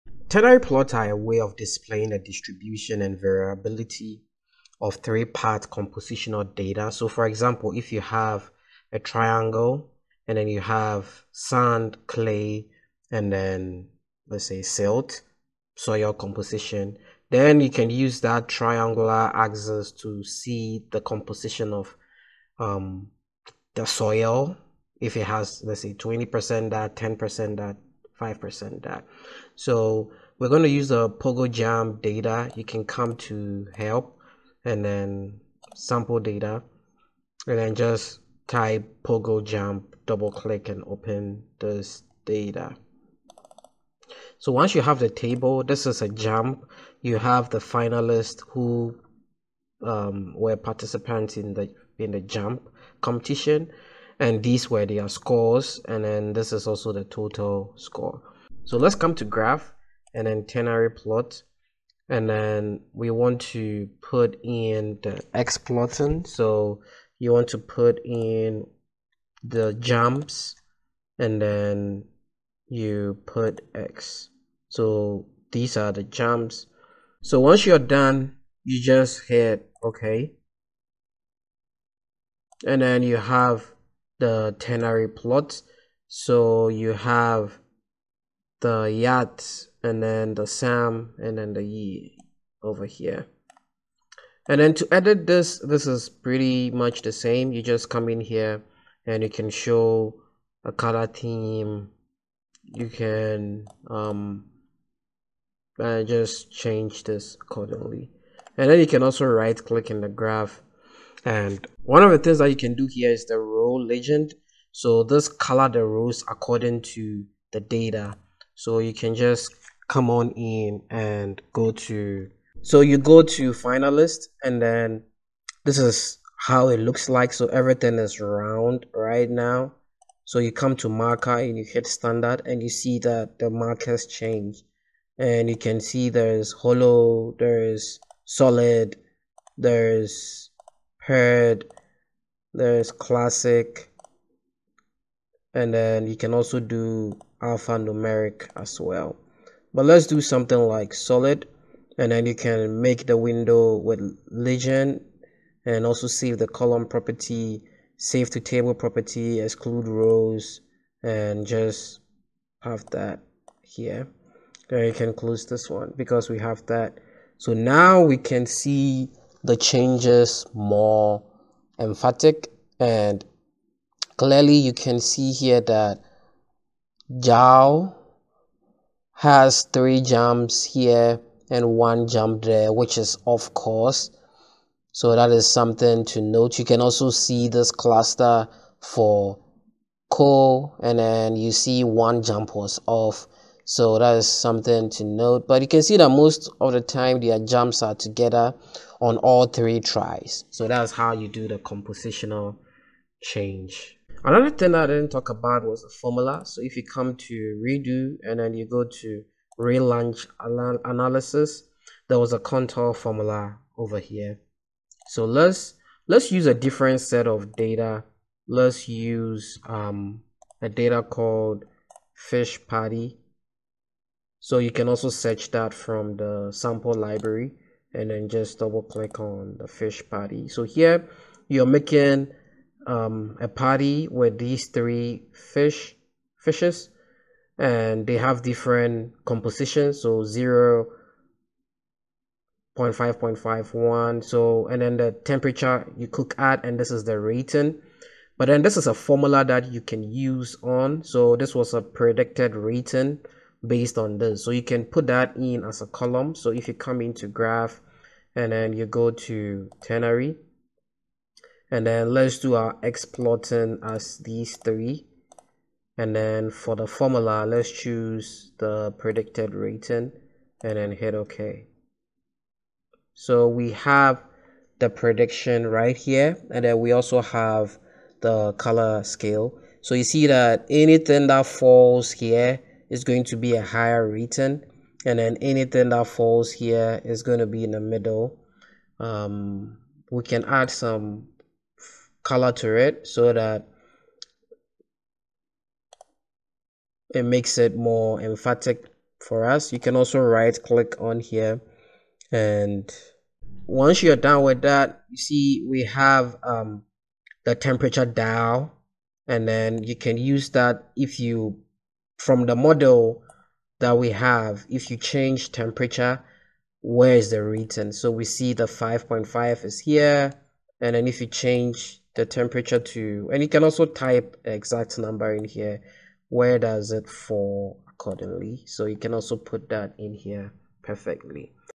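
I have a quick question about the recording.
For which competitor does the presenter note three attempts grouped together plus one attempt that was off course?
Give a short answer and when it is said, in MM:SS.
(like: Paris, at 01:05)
Jao, at 02:57.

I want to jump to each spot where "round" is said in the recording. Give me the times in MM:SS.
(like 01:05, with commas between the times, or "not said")
02:08.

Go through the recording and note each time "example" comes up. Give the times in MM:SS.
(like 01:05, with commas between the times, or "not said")
00:07.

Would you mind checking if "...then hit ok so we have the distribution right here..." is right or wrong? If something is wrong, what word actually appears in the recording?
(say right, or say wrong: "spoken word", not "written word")
wrong: "prediction", not "distribution".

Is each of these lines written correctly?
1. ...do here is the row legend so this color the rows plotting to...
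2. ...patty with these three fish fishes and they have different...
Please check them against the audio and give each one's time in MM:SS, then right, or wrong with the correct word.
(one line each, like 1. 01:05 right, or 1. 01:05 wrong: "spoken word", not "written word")
1. 01:52 wrong: "according", not "plotting"
2. 03:53 right.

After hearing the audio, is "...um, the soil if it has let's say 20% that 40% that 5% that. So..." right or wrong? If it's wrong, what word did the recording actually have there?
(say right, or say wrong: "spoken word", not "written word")
wrong: "10", not "40".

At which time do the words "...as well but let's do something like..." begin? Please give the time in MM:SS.
02:28.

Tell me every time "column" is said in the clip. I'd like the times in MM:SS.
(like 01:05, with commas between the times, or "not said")
02:36, 04:15.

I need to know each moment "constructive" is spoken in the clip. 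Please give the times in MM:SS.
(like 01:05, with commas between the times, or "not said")
not said.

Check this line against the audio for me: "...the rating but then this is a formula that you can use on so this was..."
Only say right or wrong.
right.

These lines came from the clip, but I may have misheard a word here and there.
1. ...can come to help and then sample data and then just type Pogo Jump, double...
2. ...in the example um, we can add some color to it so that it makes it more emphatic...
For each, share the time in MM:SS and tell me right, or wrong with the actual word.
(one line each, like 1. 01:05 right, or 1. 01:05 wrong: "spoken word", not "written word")
1. 00:32 right
2. 04:47 wrong: "middle", not "example".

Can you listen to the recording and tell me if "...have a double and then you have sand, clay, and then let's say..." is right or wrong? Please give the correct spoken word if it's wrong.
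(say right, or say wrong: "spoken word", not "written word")
wrong: "triangle", not "double".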